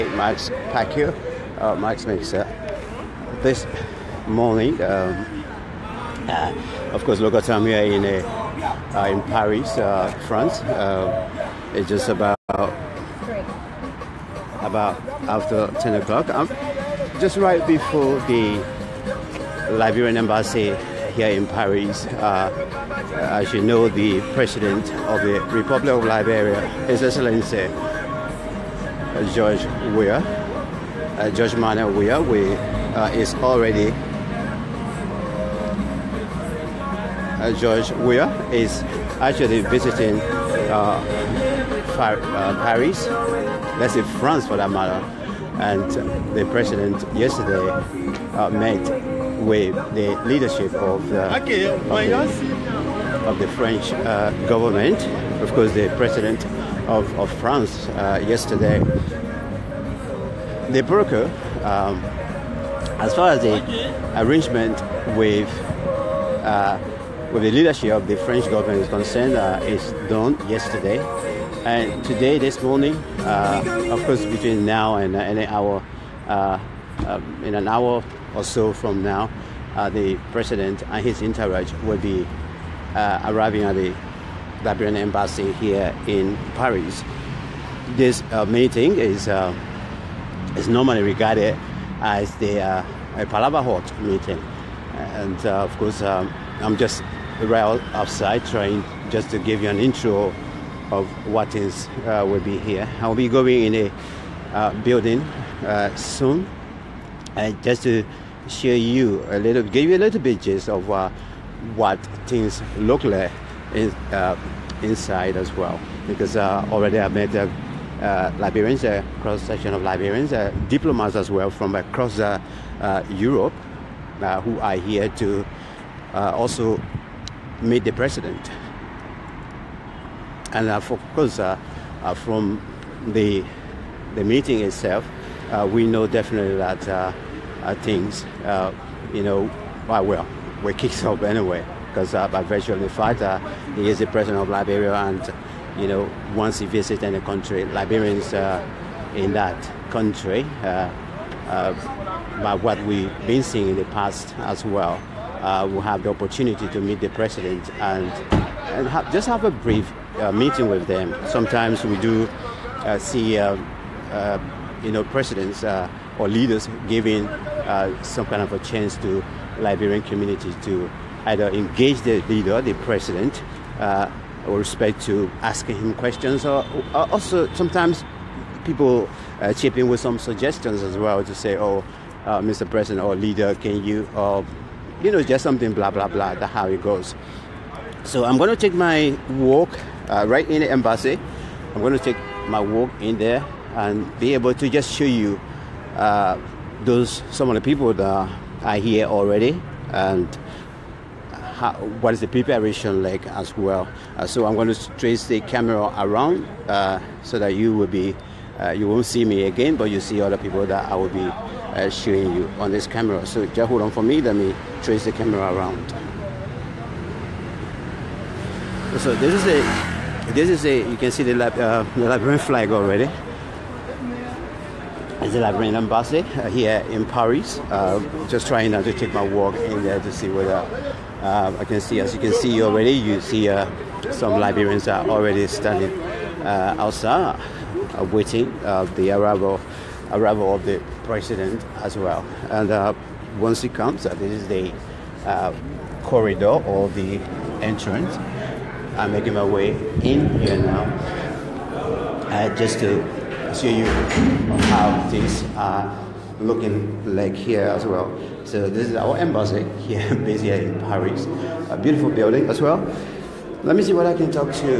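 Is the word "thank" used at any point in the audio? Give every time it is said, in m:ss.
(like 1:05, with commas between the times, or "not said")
not said.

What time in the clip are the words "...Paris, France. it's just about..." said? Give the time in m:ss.
0:09.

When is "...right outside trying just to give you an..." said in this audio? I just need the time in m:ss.
1:37.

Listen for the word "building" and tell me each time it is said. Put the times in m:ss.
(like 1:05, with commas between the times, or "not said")
1:44, 4:22.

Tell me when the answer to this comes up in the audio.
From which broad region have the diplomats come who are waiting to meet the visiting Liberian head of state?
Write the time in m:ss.
2:03.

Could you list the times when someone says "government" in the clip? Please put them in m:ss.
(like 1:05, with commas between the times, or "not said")
0:54, 1:08.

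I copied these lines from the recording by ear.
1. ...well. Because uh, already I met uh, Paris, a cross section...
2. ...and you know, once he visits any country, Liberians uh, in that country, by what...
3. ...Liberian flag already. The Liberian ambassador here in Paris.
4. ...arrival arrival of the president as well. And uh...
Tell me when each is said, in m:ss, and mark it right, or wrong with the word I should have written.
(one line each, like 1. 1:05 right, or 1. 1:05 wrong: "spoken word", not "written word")
1. 1:55 wrong: "Liberians", not "Paris"
2. 2:24 right
3. 3:42 right
4. 3:59 right.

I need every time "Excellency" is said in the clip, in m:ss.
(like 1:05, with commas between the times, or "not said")
0:27.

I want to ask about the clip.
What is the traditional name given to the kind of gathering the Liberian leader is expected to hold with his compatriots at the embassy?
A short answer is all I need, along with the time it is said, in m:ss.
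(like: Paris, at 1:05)
Palava Hut meeting, at 1:33.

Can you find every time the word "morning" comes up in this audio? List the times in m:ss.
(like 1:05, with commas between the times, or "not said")
0:04, 1:12.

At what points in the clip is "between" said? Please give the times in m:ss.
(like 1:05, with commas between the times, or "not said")
1:14.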